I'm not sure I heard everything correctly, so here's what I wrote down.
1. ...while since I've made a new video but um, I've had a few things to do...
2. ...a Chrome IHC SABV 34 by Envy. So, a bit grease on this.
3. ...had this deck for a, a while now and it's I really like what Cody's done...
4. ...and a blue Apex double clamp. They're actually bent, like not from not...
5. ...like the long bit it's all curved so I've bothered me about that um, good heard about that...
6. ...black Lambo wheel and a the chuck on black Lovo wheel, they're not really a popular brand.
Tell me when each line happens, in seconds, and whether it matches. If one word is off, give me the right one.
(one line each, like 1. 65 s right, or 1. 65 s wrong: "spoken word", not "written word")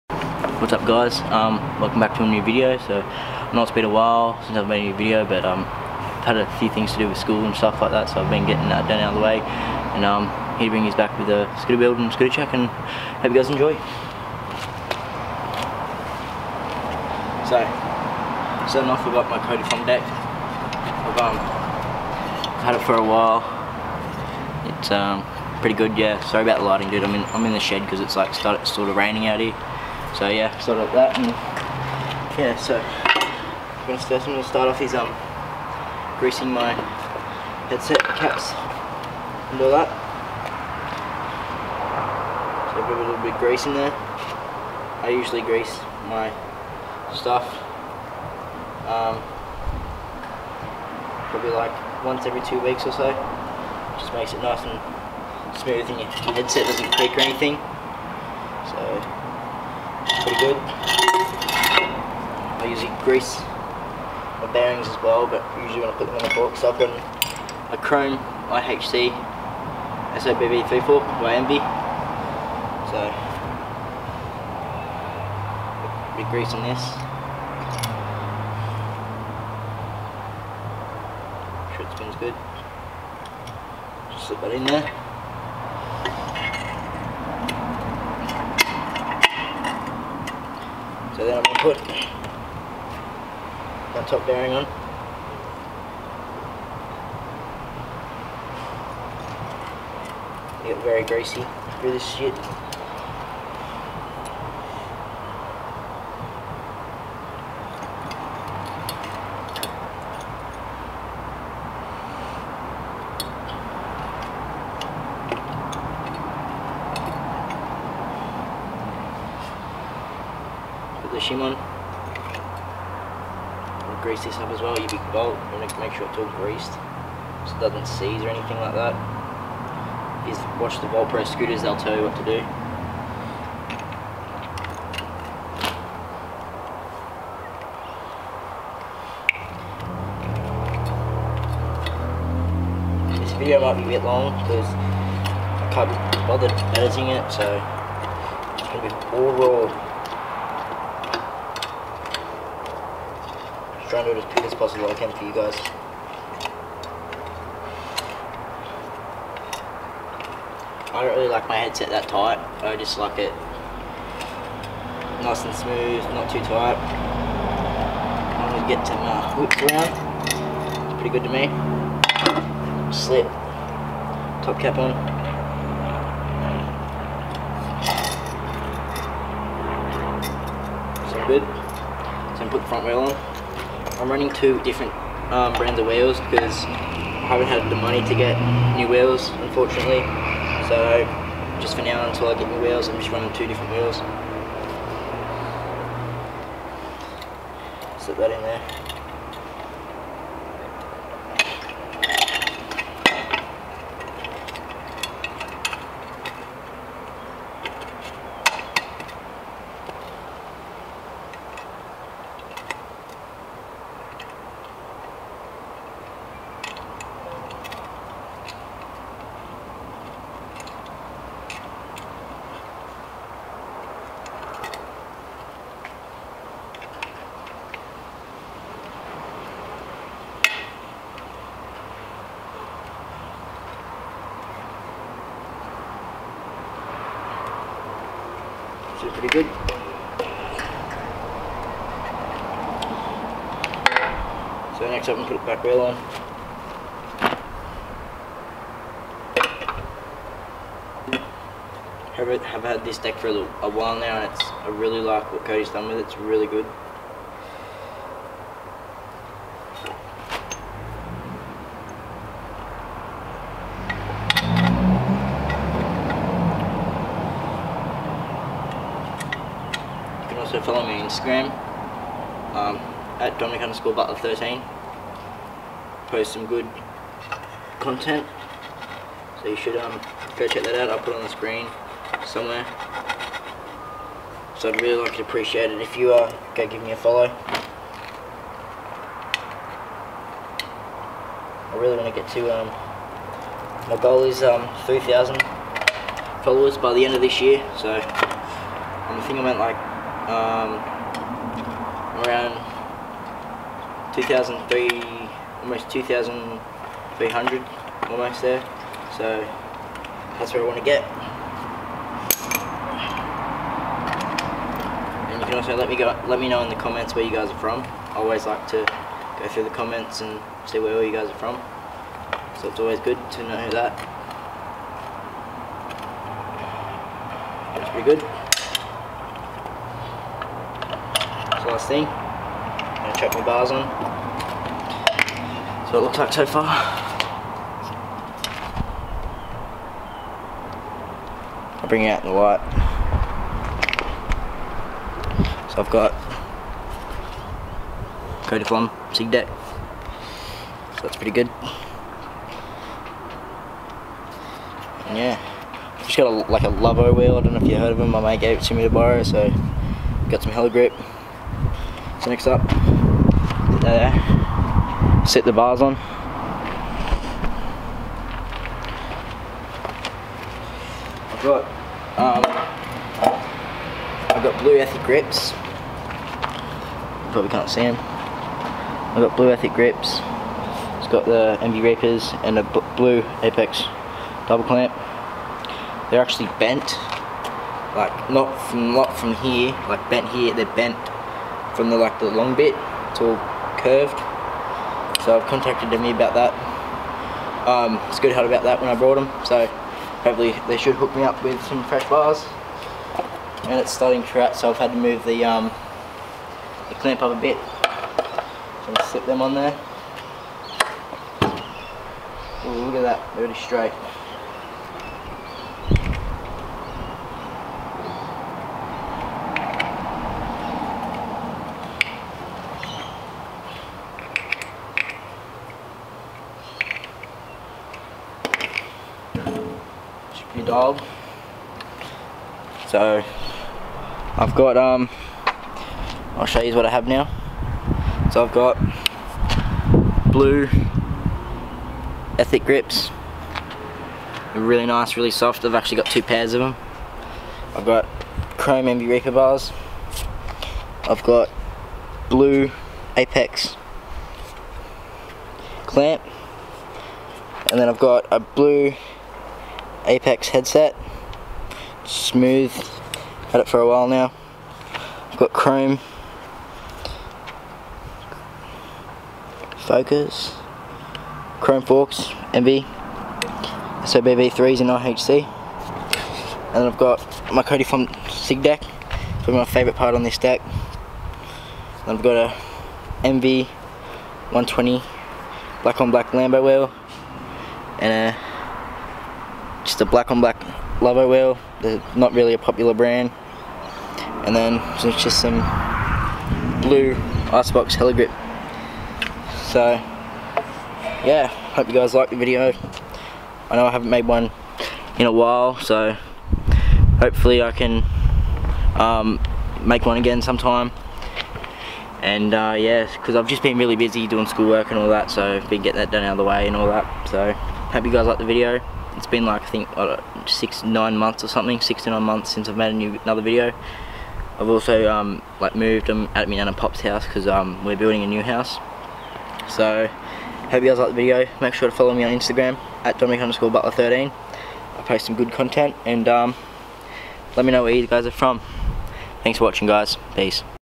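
1. 3 s right
2. 67 s right
3. 252 s right
4. 382 s right
5. 391 s wrong: "contacted", not "bothered"
6. 486 s wrong: "black", not "chuck".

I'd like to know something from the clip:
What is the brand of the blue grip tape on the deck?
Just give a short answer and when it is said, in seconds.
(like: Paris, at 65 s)
Icebox, at 497 s.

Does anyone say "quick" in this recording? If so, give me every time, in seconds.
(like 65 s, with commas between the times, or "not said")
154 s.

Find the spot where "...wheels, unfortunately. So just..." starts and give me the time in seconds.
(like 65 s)
188 s.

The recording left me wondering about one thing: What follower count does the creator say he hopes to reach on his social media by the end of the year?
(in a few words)
3,000.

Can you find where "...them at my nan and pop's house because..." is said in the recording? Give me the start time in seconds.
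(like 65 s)
526 s.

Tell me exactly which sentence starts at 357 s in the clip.
I don't know if you heard of them.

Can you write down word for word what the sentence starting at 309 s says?
So that's where I want to get.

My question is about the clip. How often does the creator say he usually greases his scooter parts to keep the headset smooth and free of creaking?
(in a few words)
once every two weeks.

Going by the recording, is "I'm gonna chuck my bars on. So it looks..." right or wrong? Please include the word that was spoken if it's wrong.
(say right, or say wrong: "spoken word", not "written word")
right.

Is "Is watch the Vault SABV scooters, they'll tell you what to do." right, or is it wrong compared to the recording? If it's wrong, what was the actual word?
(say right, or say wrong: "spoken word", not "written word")
wrong: "Pro", not "SABV".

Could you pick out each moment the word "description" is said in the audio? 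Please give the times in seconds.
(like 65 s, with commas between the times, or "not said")
not said.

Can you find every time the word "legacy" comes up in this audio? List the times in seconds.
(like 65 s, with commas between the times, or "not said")
not said.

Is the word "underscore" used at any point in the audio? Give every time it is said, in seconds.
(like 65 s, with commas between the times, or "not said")
273 s, 533 s.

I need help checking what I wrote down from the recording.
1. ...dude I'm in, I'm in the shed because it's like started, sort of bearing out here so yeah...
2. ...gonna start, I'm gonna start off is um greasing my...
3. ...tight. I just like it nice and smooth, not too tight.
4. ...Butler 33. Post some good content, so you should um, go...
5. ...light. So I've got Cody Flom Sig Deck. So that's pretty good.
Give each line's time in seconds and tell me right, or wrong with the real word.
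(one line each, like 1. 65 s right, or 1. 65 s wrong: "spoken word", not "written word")
1. 26 s wrong: "raining", not "bearing"
2. 33 s right
3. 162 s right
4. 273 s wrong: "13", not "33"
5. 342 s right.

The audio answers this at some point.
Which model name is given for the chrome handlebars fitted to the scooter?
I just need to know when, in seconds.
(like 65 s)
449 s.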